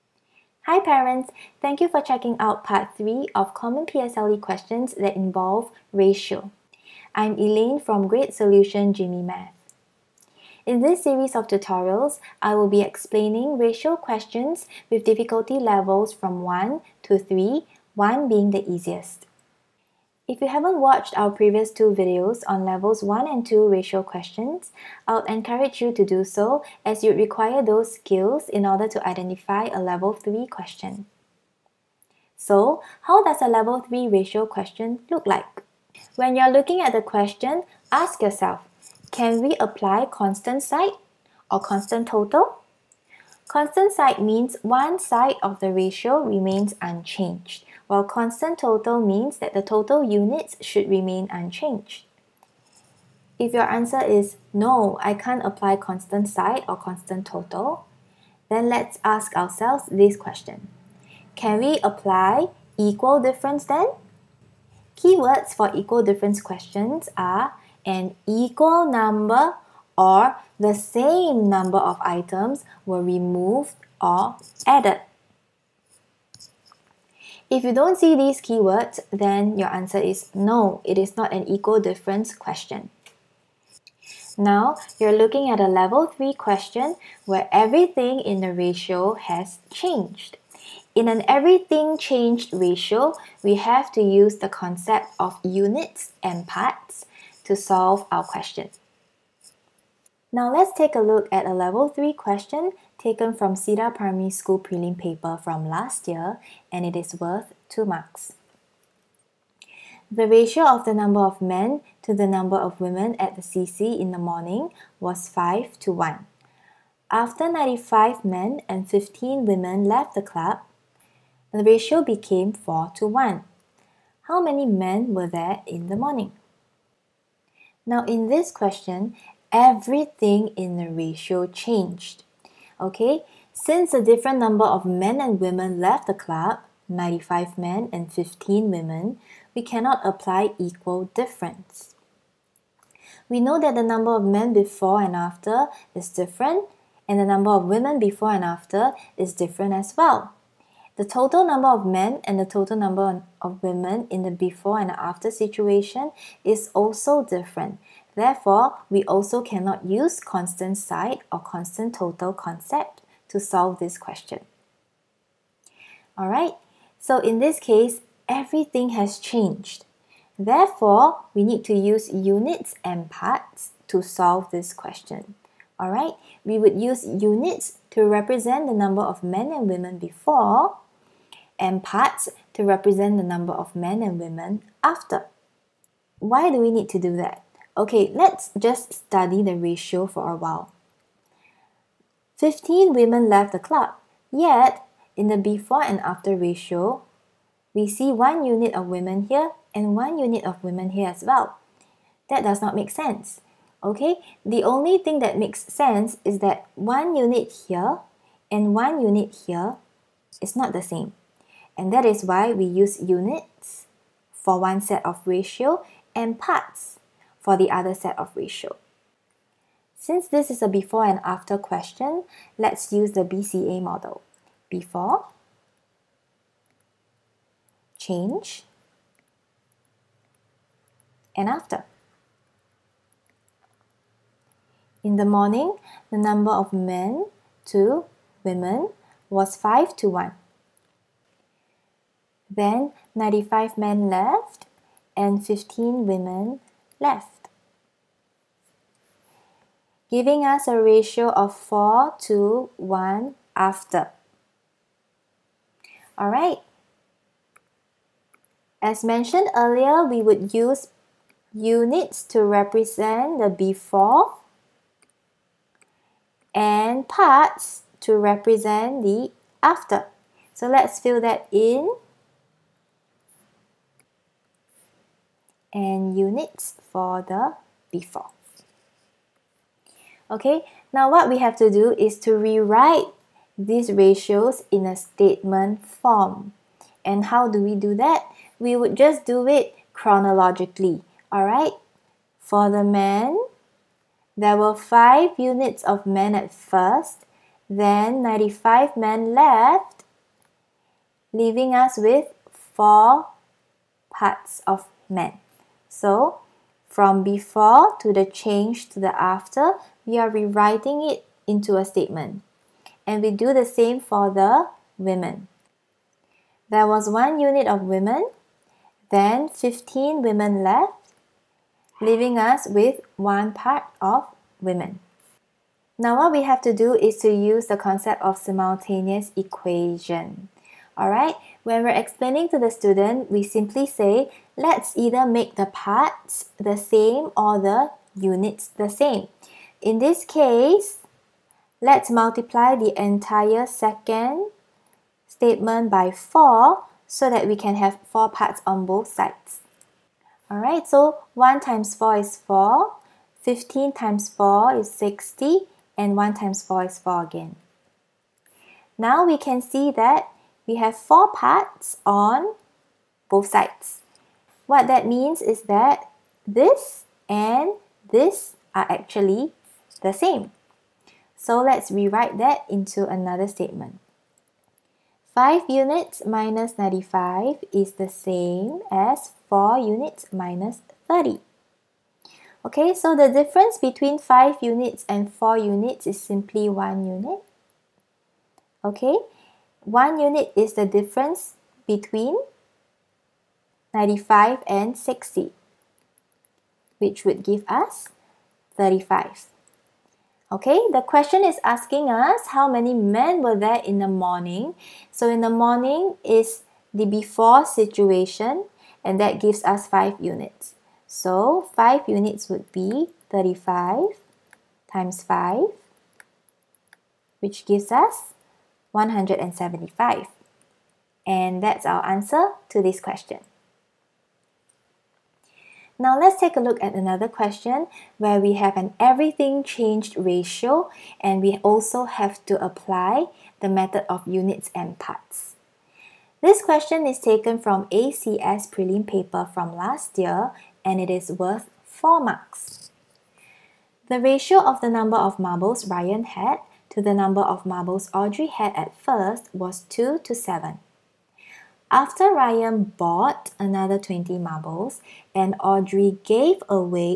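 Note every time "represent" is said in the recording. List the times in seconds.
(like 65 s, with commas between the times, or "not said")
178 s, 182 s, 262 s, 268 s.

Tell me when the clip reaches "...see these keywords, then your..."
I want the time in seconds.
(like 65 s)
77 s.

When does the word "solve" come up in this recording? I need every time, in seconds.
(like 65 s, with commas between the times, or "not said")
97 s, 163 s, 174 s.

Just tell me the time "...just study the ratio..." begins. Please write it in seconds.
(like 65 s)
188 s.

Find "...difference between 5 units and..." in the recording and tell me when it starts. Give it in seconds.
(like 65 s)
383 s.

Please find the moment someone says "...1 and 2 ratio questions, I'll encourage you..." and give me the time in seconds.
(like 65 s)
23 s.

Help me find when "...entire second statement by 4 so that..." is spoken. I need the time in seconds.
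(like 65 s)
343 s.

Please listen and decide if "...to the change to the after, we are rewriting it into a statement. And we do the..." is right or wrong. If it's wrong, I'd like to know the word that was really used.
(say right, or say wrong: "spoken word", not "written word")
right.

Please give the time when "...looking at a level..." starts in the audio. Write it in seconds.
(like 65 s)
85 s.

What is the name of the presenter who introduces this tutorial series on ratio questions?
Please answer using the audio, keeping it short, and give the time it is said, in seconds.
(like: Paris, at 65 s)
Elaine, at 7 s.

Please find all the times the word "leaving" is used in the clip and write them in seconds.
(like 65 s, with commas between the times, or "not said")
301 s, 321 s.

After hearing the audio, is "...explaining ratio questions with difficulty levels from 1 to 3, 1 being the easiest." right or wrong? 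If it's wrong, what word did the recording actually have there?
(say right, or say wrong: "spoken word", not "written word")
right.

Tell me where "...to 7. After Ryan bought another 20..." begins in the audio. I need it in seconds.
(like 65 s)
450 s.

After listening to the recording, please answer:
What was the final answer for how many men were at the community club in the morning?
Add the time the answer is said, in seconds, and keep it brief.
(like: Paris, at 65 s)
175, at 418 s.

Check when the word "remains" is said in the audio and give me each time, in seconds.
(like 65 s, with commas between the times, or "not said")
46 s, 50 s.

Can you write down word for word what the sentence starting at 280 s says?
Okay, now what we have to do is to rewrite these ratios in a statement form.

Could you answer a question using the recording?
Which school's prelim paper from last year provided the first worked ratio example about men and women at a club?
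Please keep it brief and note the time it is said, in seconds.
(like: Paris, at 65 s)
Cedar Primary School, at 103 s.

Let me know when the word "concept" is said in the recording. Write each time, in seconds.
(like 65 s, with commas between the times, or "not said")
94 s, 162 s, 327 s.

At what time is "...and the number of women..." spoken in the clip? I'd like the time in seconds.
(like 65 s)
147 s.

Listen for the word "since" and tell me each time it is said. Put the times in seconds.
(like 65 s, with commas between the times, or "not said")
133 s, 219 s.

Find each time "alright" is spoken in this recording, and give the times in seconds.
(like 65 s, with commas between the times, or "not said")
166 s, 175 s, 256 s, 291 s, 330 s, 350 s.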